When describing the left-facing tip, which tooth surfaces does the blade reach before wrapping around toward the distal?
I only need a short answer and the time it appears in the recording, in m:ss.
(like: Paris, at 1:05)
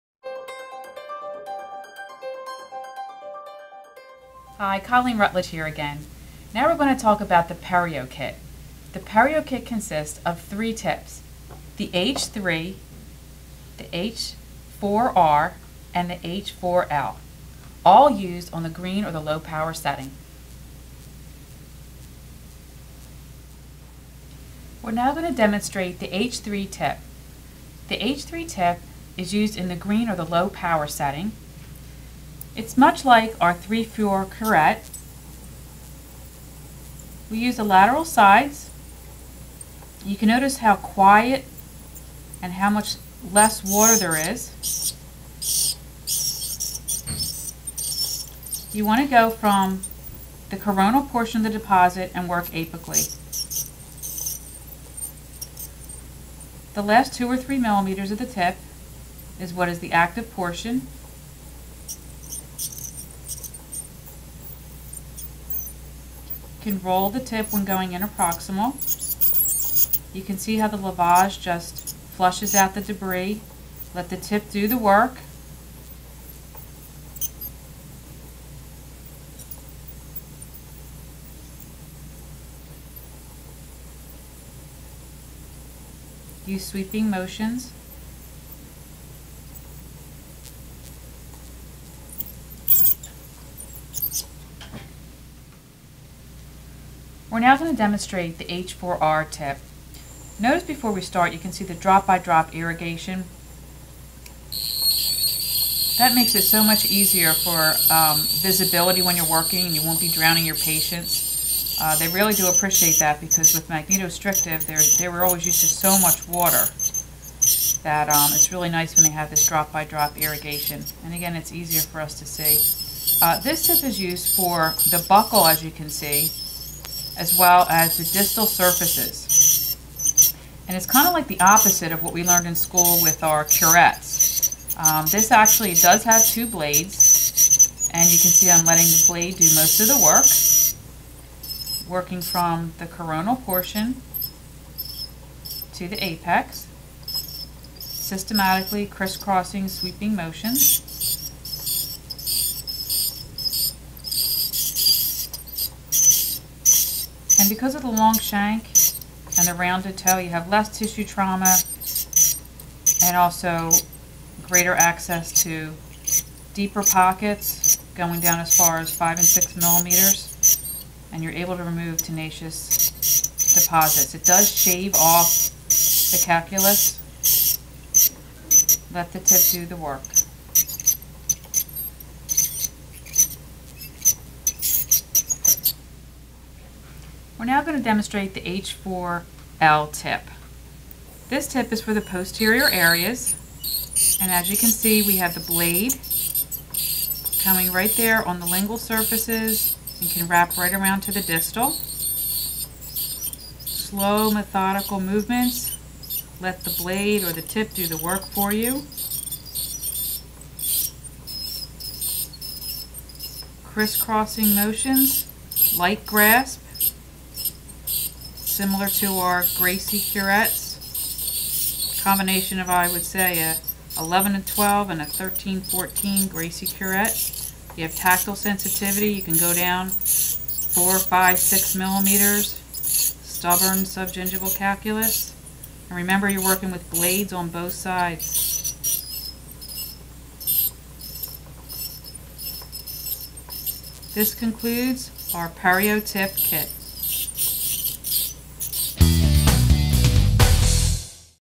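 lingual surfaces, at 3:18.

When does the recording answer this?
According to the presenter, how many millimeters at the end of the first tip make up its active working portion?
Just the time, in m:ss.
0:57.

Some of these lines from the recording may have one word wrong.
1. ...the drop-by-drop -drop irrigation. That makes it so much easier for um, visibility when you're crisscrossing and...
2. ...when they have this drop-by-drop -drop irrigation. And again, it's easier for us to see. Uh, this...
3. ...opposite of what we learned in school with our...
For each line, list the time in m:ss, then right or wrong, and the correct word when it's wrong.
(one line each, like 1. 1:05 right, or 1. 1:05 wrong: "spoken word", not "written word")
1. 1:41 wrong: "working", not "crisscrossing"
2. 1:58 right
3. 2:11 right.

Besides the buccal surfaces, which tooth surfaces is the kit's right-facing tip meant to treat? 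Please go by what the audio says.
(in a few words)
distal surfaces.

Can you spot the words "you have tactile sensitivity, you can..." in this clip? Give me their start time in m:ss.
3:47.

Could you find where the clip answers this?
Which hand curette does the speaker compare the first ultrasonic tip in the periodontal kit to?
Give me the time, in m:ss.
0:33.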